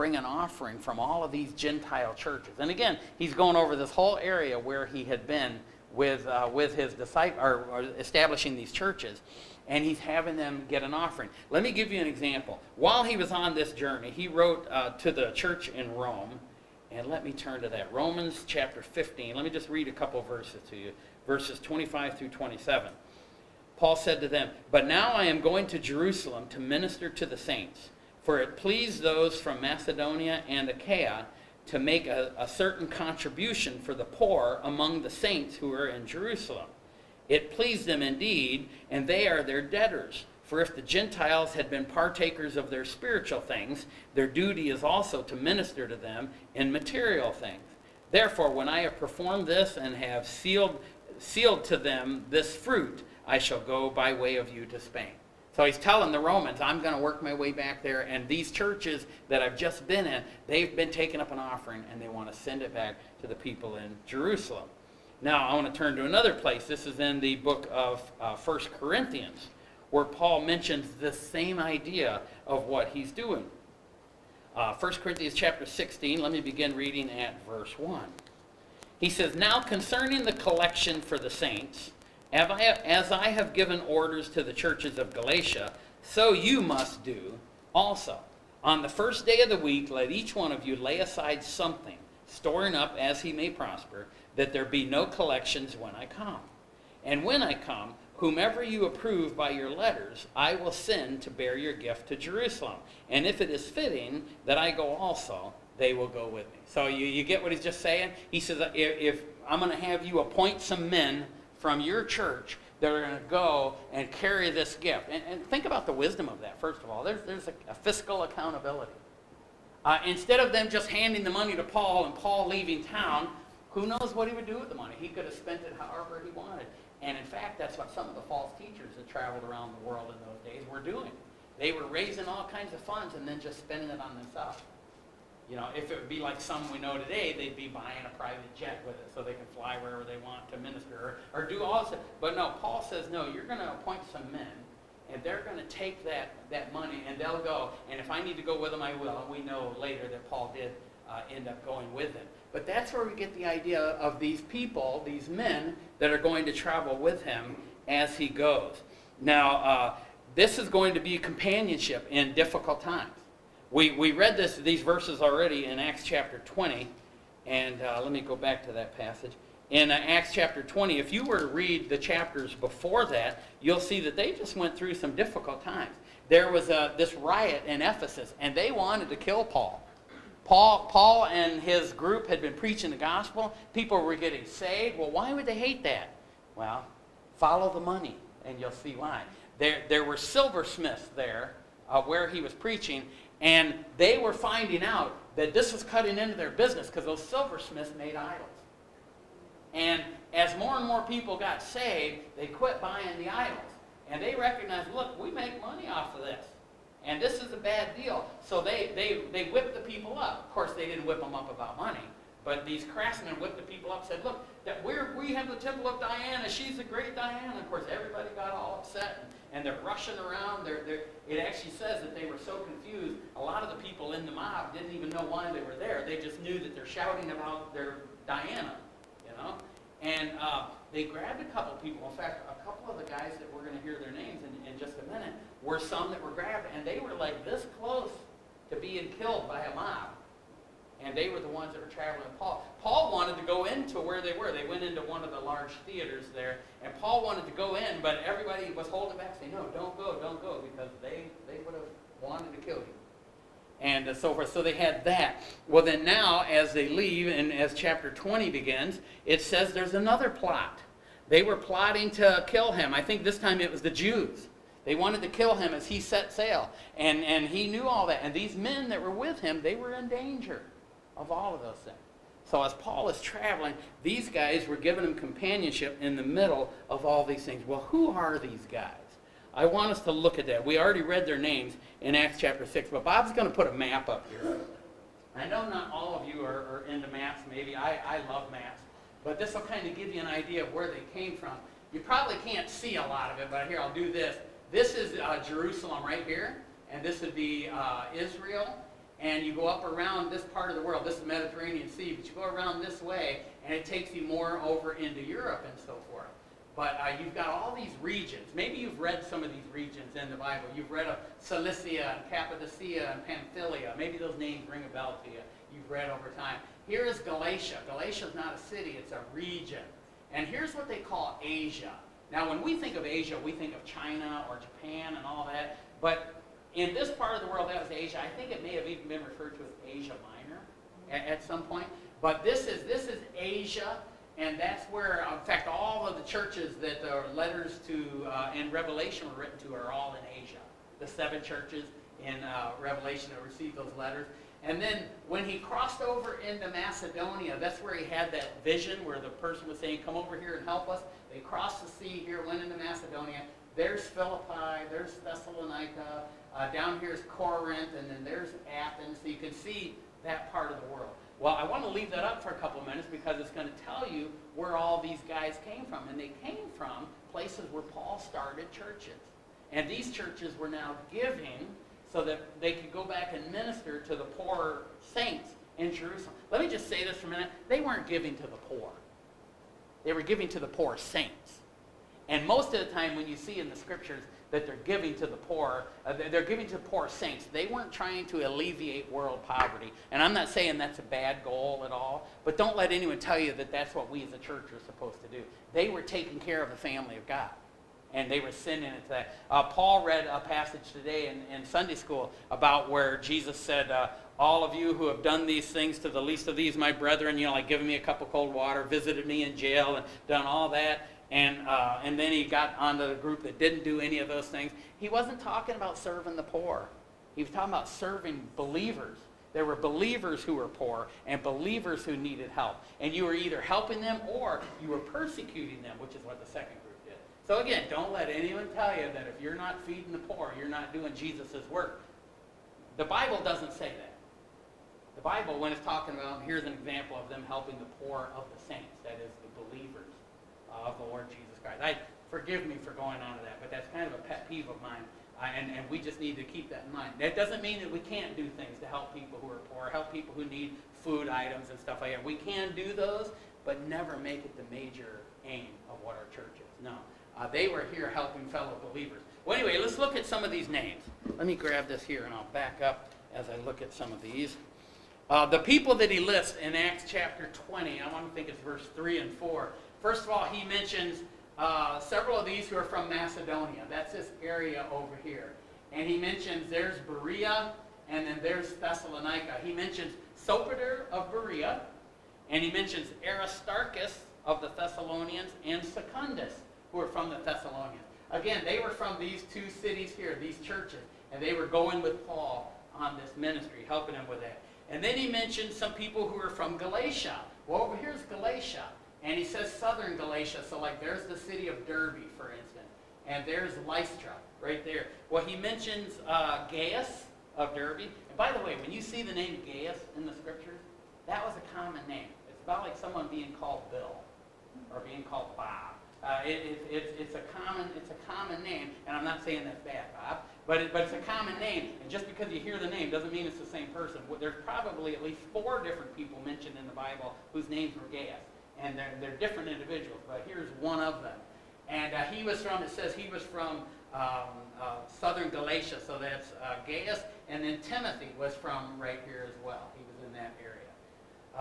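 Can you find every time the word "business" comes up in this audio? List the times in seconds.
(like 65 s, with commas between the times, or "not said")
196 s.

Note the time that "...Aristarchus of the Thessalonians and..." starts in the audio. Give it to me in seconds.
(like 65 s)
483 s.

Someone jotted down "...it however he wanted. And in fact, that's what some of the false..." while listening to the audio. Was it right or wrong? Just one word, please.
right.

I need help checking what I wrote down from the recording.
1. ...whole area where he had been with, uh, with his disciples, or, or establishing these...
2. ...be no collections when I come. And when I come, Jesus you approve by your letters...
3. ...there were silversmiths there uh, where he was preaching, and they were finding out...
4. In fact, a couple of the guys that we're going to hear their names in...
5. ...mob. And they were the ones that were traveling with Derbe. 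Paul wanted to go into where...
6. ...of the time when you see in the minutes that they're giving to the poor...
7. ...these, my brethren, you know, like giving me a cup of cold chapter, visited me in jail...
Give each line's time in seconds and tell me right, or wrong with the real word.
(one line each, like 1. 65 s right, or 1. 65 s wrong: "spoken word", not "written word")
1. 3 s right
2. 94 s wrong: "Whomever", not "Jesus"
3. 189 s right
4. 232 s right
5. 239 s wrong: "Paul", not "Derbe"
6. 382 s wrong: "scriptures", not "minutes"
7. 406 s wrong: "water", not "chapter".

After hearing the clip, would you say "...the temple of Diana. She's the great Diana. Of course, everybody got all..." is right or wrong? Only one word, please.
right.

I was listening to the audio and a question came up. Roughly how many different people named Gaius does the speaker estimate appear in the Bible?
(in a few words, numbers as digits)
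4.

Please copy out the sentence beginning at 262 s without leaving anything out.
I think this time it was the Jews.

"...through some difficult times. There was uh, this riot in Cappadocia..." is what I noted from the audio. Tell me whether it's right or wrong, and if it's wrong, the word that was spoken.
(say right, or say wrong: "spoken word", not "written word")
wrong: "Ephesus", not "Cappadocia".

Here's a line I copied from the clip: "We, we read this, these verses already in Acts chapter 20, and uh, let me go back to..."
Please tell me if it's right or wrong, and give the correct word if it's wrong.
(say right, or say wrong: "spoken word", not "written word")
right.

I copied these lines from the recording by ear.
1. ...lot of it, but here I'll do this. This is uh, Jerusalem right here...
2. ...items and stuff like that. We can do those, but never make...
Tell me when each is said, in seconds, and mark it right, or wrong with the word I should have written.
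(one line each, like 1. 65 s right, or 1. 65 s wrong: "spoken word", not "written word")
1. 293 s right
2. 451 s right.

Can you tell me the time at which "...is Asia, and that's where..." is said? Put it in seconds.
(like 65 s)
333 s.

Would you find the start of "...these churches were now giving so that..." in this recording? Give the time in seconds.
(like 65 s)
369 s.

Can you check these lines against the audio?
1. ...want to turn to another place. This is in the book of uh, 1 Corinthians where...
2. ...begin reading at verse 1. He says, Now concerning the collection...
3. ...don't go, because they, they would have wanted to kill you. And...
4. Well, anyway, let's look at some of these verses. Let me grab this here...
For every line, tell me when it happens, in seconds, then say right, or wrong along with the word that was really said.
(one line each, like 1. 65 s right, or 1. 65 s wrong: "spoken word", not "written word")
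1. 65 s right
2. 76 s right
3. 250 s right
4. 459 s wrong: "names", not "verses".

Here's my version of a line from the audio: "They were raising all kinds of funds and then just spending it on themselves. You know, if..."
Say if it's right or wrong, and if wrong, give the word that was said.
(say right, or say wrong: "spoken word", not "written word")
right.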